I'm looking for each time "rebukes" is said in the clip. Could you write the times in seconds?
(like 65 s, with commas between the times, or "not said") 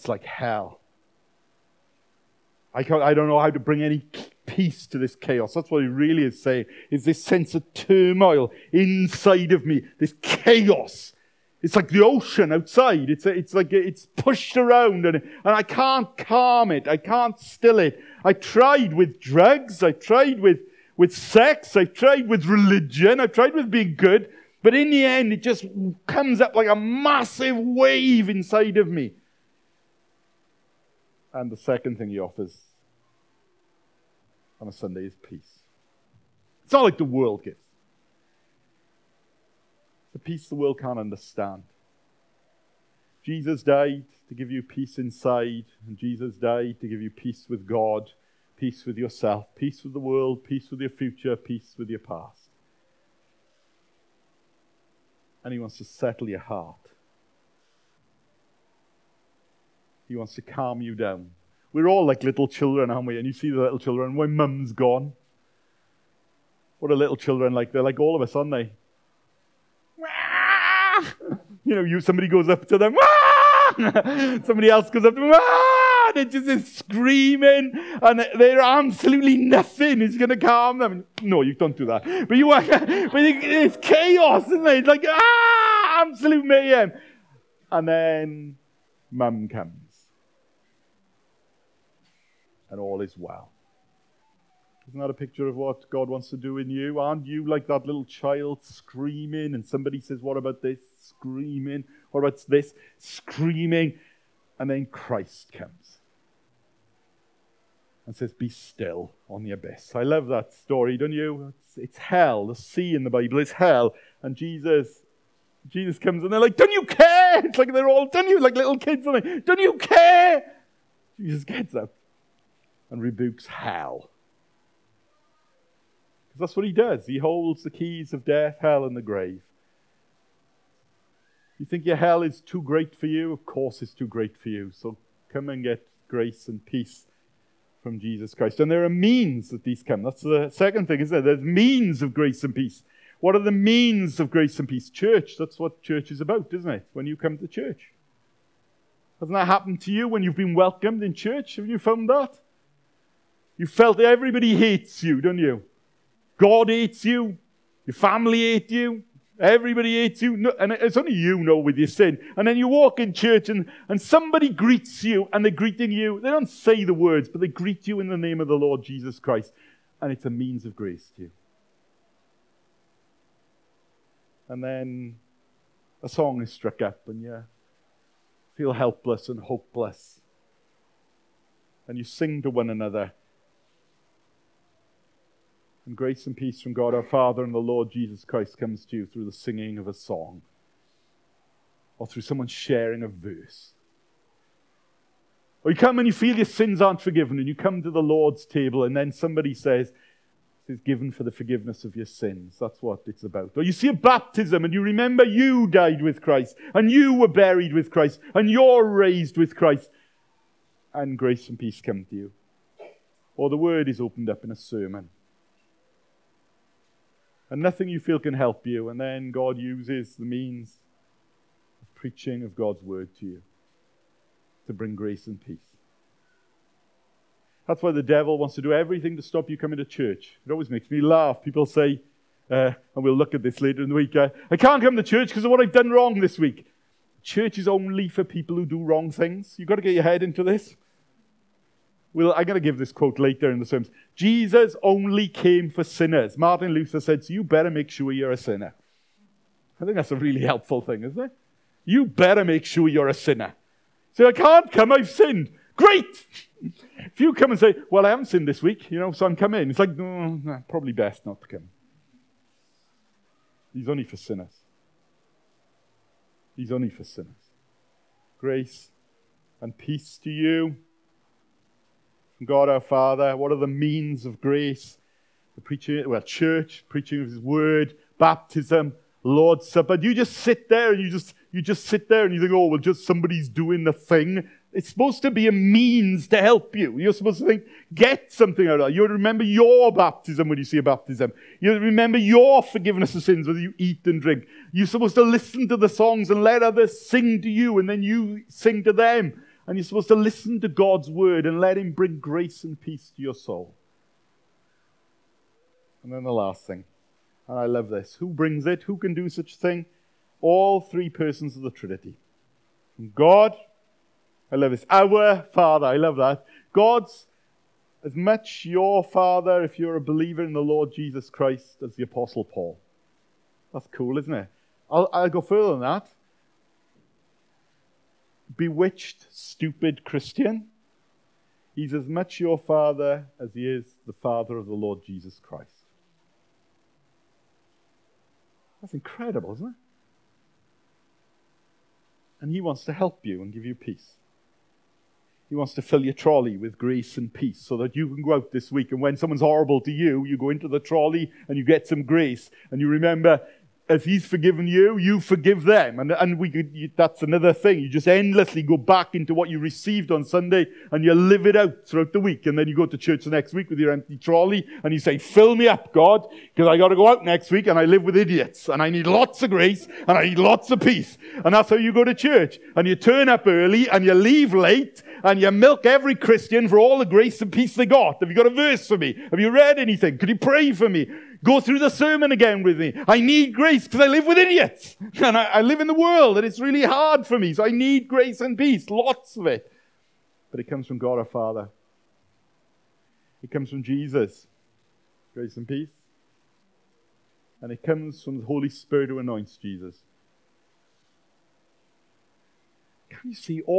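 123 s.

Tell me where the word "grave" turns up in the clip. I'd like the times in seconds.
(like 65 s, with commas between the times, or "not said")
129 s.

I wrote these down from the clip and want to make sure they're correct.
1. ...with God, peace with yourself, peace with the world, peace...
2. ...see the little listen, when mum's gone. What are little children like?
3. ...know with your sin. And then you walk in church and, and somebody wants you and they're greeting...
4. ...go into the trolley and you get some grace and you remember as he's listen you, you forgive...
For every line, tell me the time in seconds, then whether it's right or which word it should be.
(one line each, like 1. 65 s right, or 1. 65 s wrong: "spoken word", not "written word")
1. 47 s right
2. 63 s wrong: "children", not "listen"
3. 161 s wrong: "greets", not "wants"
4. 350 s wrong: "forgiven", not "listen".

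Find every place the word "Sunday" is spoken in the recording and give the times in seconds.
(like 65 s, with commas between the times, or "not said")
34 s, 360 s.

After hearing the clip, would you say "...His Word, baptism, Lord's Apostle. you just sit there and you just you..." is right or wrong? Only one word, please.
wrong.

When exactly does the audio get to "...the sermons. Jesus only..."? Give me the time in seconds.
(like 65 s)
243 s.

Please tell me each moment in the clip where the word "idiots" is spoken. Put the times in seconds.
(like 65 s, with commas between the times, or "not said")
368 s, 384 s.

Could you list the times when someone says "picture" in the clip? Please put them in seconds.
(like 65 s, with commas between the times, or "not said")
95 s.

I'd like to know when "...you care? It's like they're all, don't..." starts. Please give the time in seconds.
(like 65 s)
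116 s.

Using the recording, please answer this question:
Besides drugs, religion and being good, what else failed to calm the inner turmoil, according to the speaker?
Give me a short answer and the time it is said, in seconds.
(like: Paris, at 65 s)
sex, at 21 s.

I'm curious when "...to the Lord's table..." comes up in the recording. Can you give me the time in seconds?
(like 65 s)
197 s.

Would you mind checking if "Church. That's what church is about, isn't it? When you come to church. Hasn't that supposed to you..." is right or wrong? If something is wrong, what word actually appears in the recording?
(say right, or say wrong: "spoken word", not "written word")
wrong: "happened", not "supposed".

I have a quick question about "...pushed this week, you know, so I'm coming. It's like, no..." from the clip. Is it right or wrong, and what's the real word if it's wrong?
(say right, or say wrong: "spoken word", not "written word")
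wrong: "sinned", not "pushed".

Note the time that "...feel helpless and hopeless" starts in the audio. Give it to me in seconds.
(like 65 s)
178 s.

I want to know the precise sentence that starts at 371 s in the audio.
And that's how you go to church.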